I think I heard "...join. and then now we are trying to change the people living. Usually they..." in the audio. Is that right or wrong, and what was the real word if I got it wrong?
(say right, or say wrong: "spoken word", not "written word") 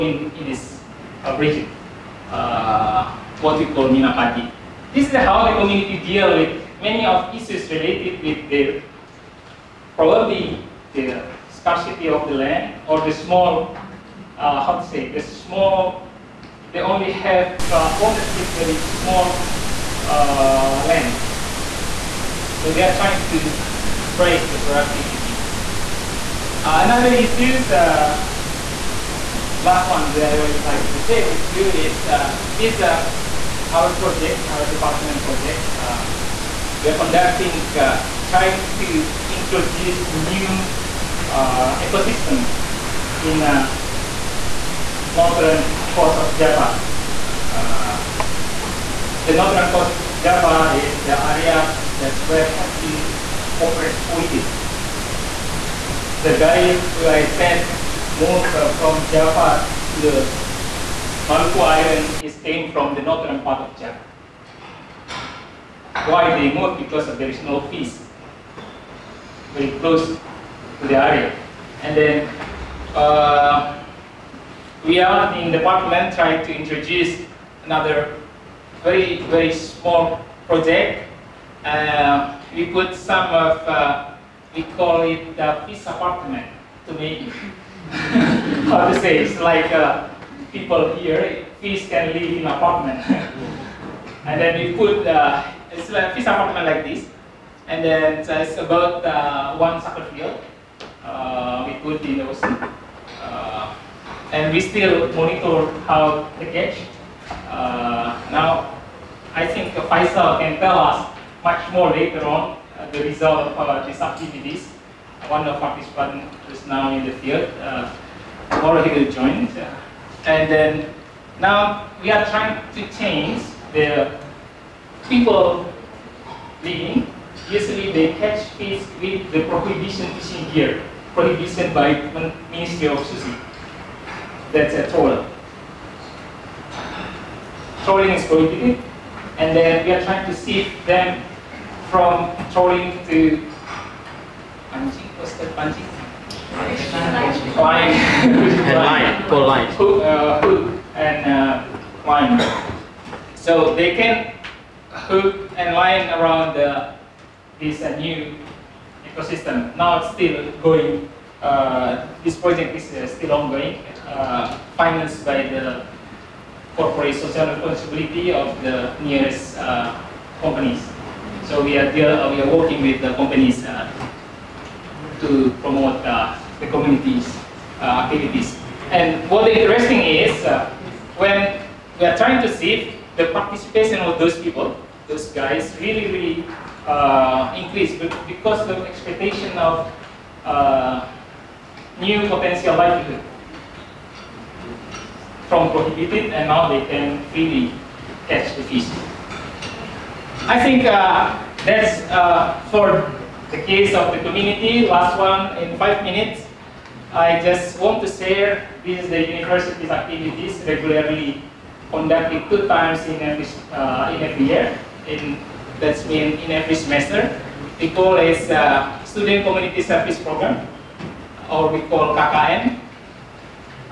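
right.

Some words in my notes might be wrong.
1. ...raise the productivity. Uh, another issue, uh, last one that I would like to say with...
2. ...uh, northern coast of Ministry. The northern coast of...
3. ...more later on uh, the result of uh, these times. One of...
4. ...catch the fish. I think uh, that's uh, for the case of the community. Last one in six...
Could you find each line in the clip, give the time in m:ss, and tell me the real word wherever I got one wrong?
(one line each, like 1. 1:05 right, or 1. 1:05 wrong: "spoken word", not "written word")
1. 0:24 right
2. 0:43 wrong: "Java", not "Ministry"
3. 1:51 wrong: "activities", not "times"
4. 3:18 wrong: "five", not "six".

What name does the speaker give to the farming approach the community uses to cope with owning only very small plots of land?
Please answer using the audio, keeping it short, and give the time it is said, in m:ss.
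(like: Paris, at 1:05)
Minapadi, at 0:03.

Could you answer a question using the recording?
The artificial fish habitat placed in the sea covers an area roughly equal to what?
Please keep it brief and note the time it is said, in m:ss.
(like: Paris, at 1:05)
One soccer field, at 1:39.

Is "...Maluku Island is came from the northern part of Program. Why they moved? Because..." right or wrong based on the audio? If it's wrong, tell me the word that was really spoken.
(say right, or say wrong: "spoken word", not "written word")
wrong: "Java", not "Program".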